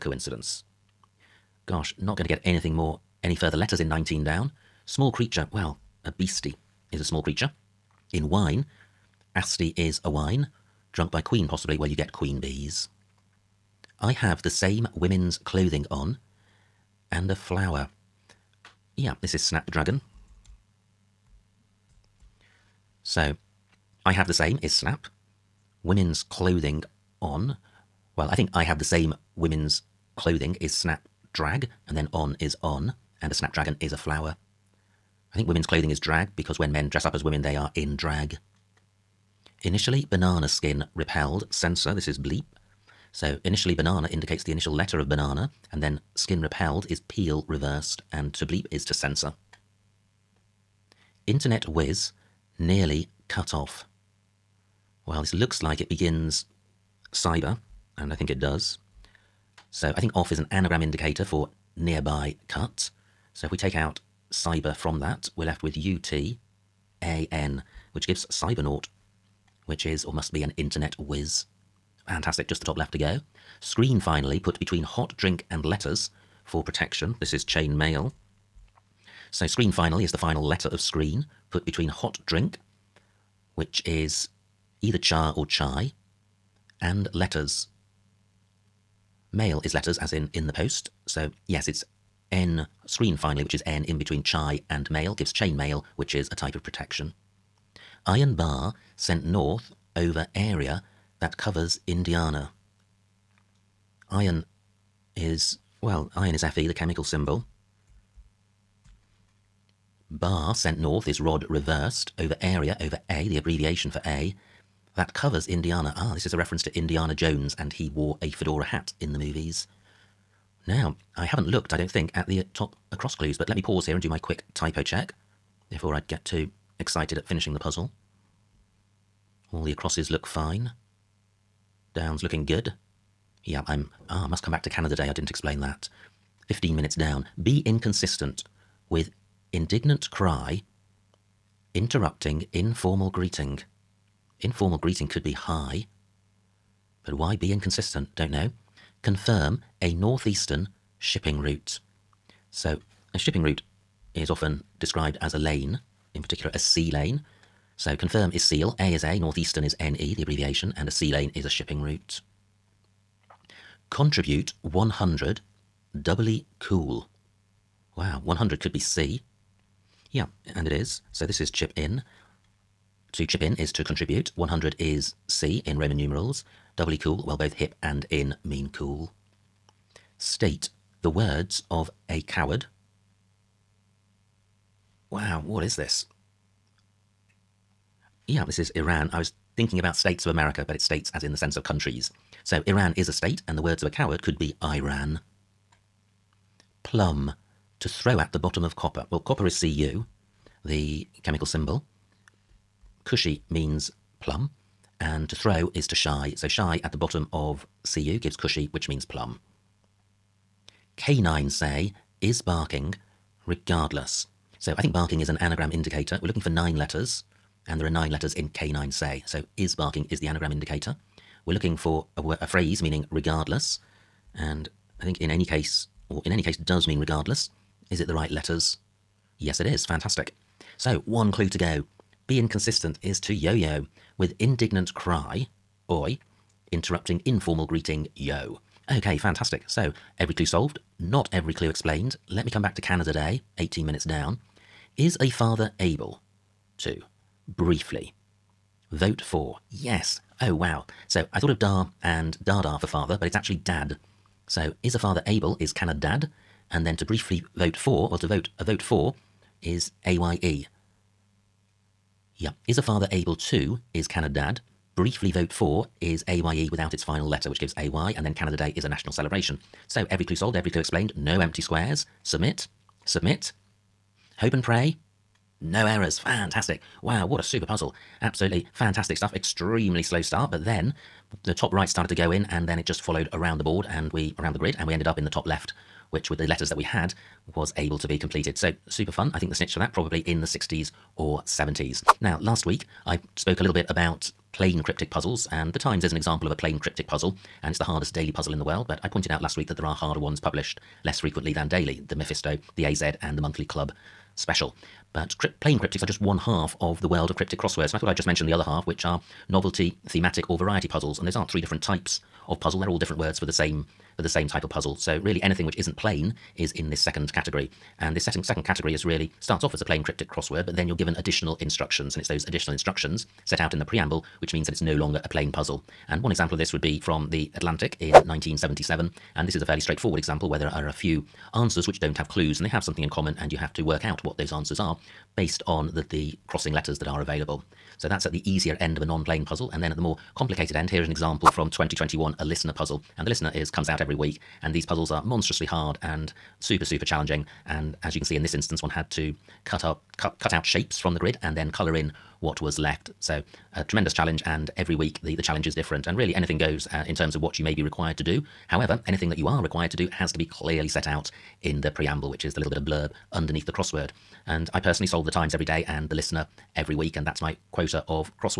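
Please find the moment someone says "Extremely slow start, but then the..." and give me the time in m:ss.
4:39.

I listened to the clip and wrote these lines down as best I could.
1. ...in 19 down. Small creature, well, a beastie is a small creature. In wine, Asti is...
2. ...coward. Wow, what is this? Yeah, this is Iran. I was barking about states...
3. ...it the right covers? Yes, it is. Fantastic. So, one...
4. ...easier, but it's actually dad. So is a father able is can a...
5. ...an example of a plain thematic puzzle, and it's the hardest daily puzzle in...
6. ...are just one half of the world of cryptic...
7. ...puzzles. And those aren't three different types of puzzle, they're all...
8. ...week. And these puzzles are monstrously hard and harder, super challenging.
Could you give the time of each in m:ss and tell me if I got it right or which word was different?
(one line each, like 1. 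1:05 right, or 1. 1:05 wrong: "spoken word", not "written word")
1. 0:03 right
2. 3:02 wrong: "thinking", not "barking"
3. 3:47 wrong: "letters", not "covers"
4. 4:12 wrong: "father", not "easier"
5. 4:56 wrong: "cryptic", not "thematic"
6. 5:06 right
7. 5:10 right
8. 5:44 wrong: "super", not "harder".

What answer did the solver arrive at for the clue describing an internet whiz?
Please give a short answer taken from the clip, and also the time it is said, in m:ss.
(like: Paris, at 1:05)
cybernaut, at 1:08.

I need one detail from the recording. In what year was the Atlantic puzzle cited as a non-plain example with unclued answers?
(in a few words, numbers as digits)
1977.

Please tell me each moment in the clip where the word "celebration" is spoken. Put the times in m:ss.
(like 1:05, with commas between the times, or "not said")
4:29.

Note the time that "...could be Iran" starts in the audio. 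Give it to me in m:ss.
3:14.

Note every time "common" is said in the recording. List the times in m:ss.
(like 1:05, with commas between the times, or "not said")
5:33.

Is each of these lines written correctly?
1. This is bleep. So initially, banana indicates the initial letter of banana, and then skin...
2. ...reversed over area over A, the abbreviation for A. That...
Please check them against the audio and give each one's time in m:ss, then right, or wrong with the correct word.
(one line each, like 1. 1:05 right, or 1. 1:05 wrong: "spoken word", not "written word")
1. 0:41 right
2. 1:51 right.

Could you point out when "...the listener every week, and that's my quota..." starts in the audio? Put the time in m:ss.
6:06.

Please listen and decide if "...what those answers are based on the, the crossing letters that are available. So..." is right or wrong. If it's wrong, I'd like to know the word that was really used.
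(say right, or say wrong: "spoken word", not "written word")
right.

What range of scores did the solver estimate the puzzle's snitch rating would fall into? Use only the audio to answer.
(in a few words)
60s or 70s.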